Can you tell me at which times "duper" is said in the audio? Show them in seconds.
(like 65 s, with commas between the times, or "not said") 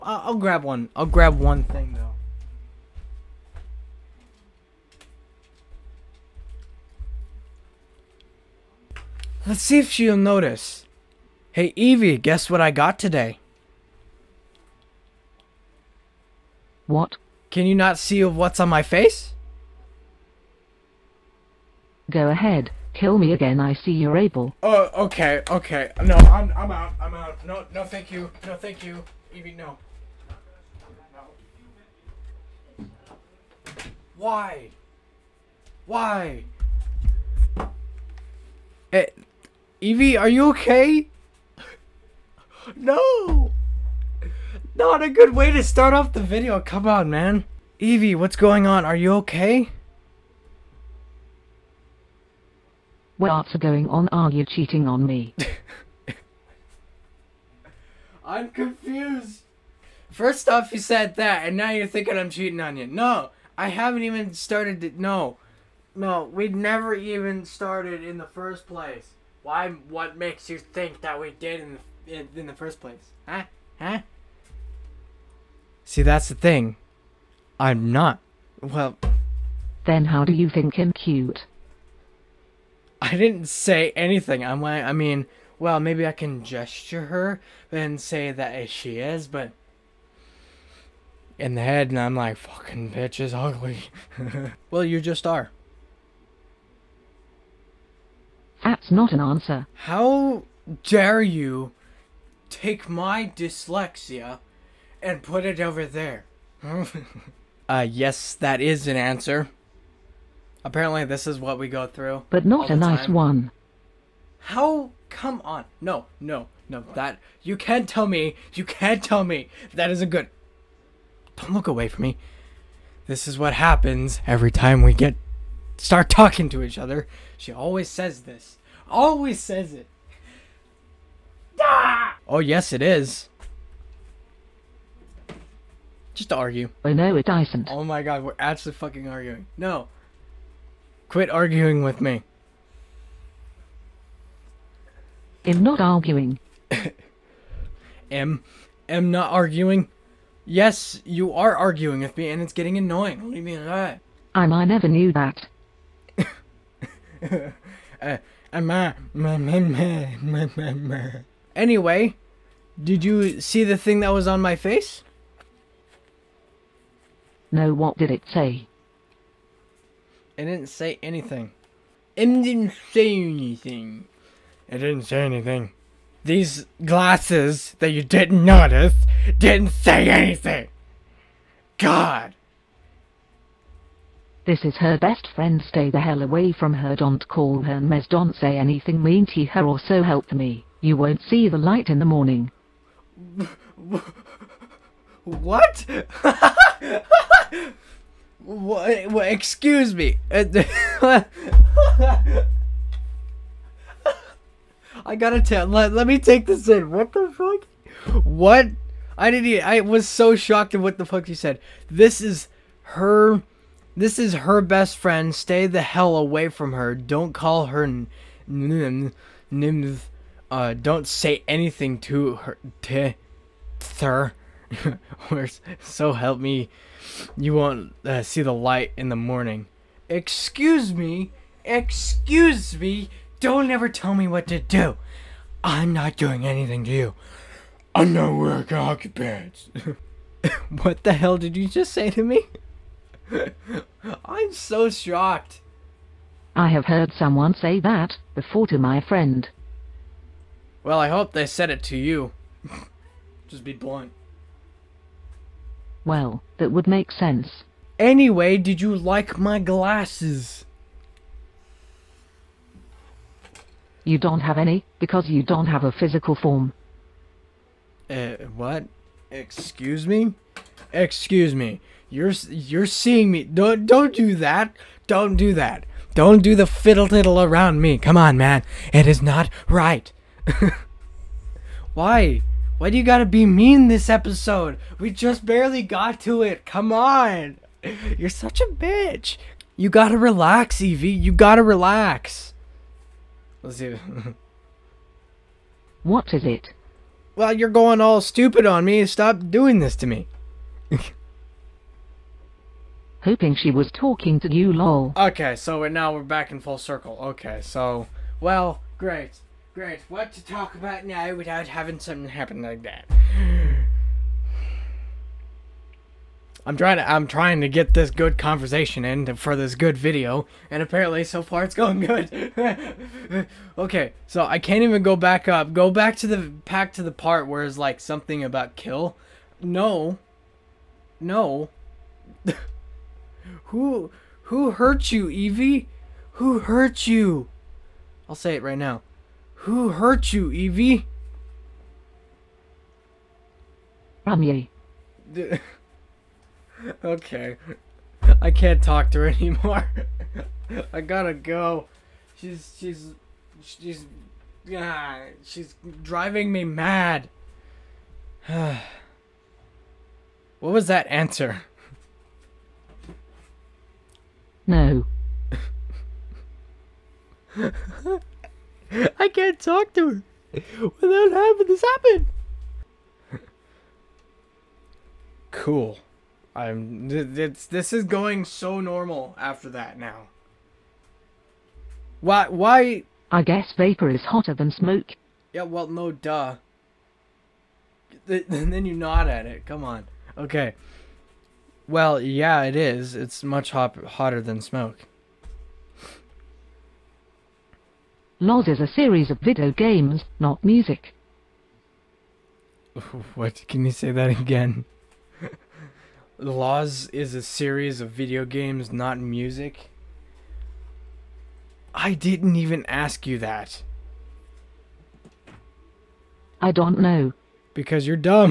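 not said.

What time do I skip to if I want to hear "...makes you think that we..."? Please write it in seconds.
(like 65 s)
70 s.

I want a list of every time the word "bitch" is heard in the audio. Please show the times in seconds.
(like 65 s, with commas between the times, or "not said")
92 s, 288 s.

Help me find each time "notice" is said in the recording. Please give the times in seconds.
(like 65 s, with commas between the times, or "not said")
10 s, 178 s.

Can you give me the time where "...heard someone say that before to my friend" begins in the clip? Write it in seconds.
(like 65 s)
246 s.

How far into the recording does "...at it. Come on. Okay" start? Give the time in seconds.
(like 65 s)
389 s.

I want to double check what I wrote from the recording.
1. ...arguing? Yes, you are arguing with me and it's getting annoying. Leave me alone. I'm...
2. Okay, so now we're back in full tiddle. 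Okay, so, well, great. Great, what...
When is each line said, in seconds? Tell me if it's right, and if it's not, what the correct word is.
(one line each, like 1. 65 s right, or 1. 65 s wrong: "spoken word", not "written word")
1. 149 s right
2. 305 s wrong: "circle", not "tiddle".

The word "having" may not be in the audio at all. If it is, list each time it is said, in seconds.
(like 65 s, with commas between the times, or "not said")
311 s, 371 s.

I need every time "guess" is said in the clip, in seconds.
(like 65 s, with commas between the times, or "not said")
12 s, 383 s.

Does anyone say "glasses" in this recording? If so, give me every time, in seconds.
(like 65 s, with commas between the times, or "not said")
176 s, 259 s.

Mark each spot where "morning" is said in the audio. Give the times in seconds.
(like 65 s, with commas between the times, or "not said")
192 s, 229 s.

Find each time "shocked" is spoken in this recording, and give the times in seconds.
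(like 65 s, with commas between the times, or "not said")
210 s, 244 s.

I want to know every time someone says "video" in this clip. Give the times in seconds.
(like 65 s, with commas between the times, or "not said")
46 s, 319 s, 399 s, 408 s.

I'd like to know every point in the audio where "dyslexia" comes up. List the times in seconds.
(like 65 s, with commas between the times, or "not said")
103 s.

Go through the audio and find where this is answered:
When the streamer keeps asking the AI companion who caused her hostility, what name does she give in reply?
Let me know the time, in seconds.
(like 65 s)
344 s.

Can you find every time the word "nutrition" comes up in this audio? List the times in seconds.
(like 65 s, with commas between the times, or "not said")
not said.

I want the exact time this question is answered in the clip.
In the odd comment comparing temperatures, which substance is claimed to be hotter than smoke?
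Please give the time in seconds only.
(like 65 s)
383 s.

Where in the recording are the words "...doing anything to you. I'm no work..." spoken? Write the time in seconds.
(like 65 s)
236 s.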